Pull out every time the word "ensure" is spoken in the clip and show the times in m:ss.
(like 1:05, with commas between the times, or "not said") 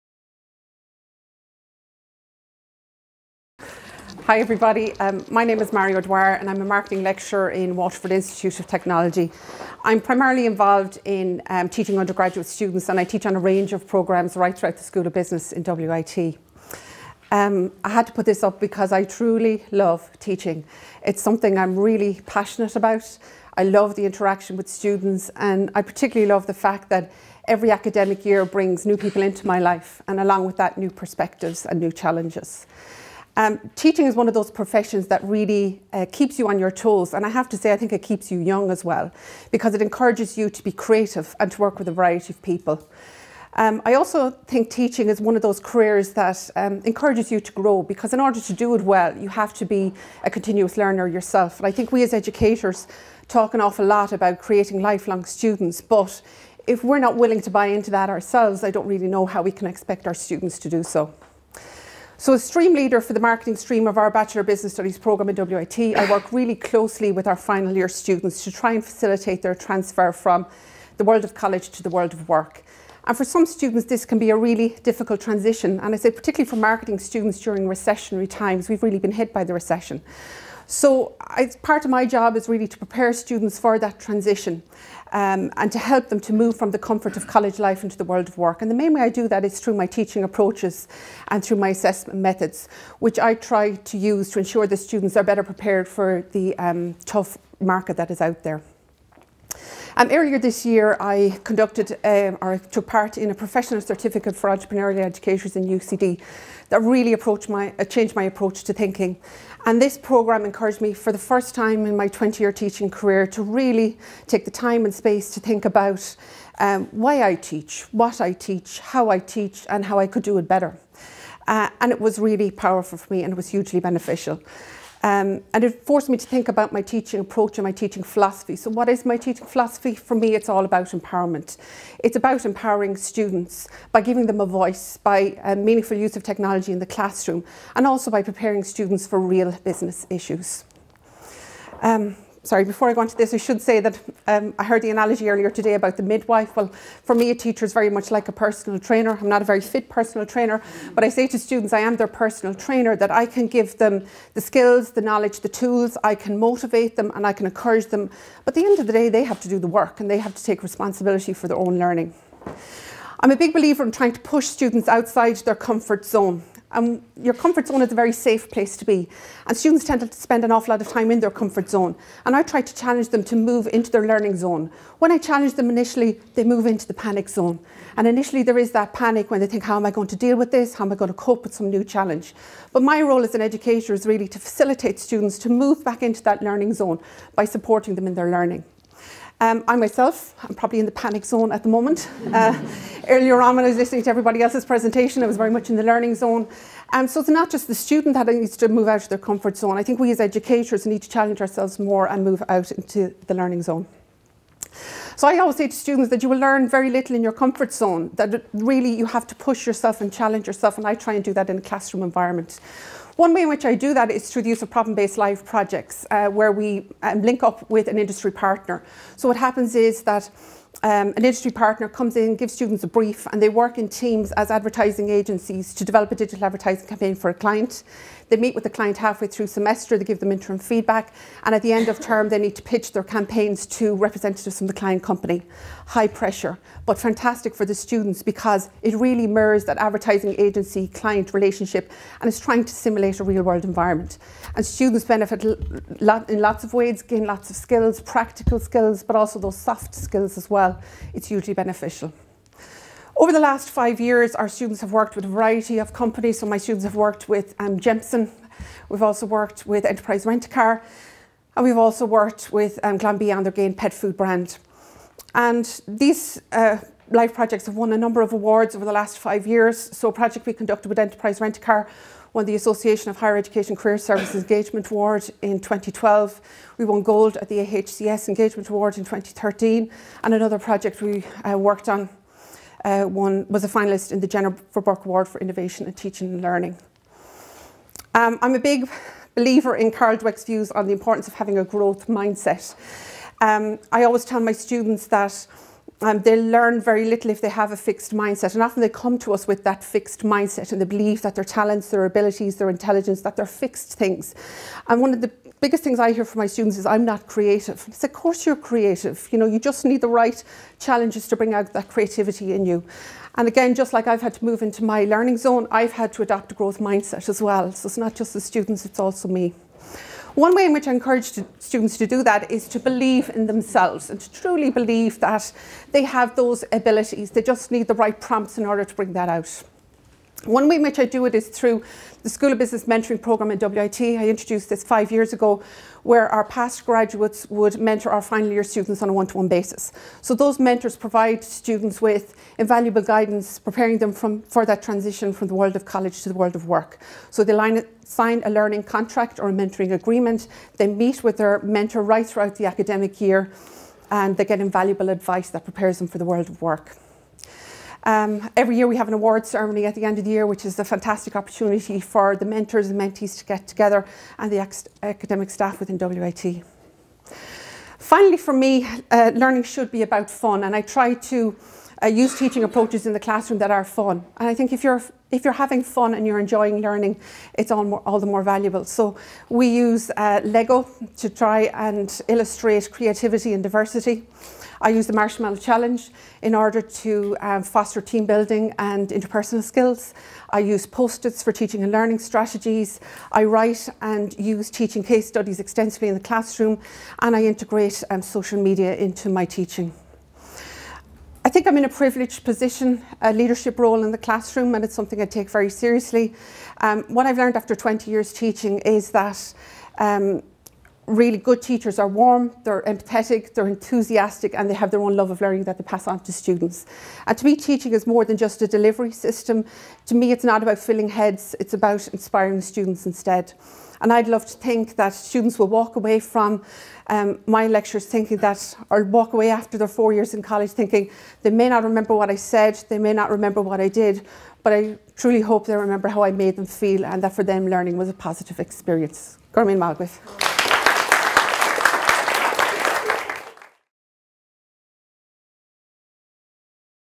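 1:34.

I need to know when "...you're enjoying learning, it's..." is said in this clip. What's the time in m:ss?
6:16.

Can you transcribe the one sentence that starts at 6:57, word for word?
And to me, teaching is more than just a delivery system.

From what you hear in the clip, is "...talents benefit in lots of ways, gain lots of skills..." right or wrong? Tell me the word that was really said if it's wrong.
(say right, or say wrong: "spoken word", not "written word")
wrong: "students", not "talents".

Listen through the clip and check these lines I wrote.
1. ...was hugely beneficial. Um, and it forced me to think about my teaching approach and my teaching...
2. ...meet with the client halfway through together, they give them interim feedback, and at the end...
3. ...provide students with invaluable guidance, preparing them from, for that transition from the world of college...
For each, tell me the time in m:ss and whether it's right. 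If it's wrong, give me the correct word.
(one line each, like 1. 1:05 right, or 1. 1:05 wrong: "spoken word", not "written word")
1. 2:03 right
2. 3:48 wrong: "semester", not "together"
3. 5:40 right.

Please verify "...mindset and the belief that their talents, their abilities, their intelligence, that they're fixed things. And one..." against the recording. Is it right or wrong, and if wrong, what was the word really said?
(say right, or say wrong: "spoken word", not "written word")
right.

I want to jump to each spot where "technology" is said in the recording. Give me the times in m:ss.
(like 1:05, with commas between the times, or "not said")
0:08, 2:16.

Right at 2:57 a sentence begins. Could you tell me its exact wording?
And initially there is that panic when they think, how am I going to deal with this?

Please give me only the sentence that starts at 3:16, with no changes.
Um, so it's not just the student that needs to move out of their comfort zone.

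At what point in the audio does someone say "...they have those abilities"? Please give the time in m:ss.
5:25.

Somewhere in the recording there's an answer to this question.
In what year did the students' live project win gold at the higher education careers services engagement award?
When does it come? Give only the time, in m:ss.
4:39.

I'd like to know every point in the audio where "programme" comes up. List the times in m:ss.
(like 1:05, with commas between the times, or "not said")
0:13, 1:04, 1:49, 5:33.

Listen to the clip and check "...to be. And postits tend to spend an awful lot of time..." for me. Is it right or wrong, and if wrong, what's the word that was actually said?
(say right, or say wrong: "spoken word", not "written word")
wrong: "students", not "postits".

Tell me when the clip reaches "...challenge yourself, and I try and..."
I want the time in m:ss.
3:30.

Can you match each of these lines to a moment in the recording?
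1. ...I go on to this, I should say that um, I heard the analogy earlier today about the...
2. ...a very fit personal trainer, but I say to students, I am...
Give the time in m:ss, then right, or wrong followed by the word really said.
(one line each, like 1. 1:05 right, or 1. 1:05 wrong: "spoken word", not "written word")
1. 2:22 right
2. 2:29 right.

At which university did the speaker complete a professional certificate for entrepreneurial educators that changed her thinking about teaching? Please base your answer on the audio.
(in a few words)
UCD.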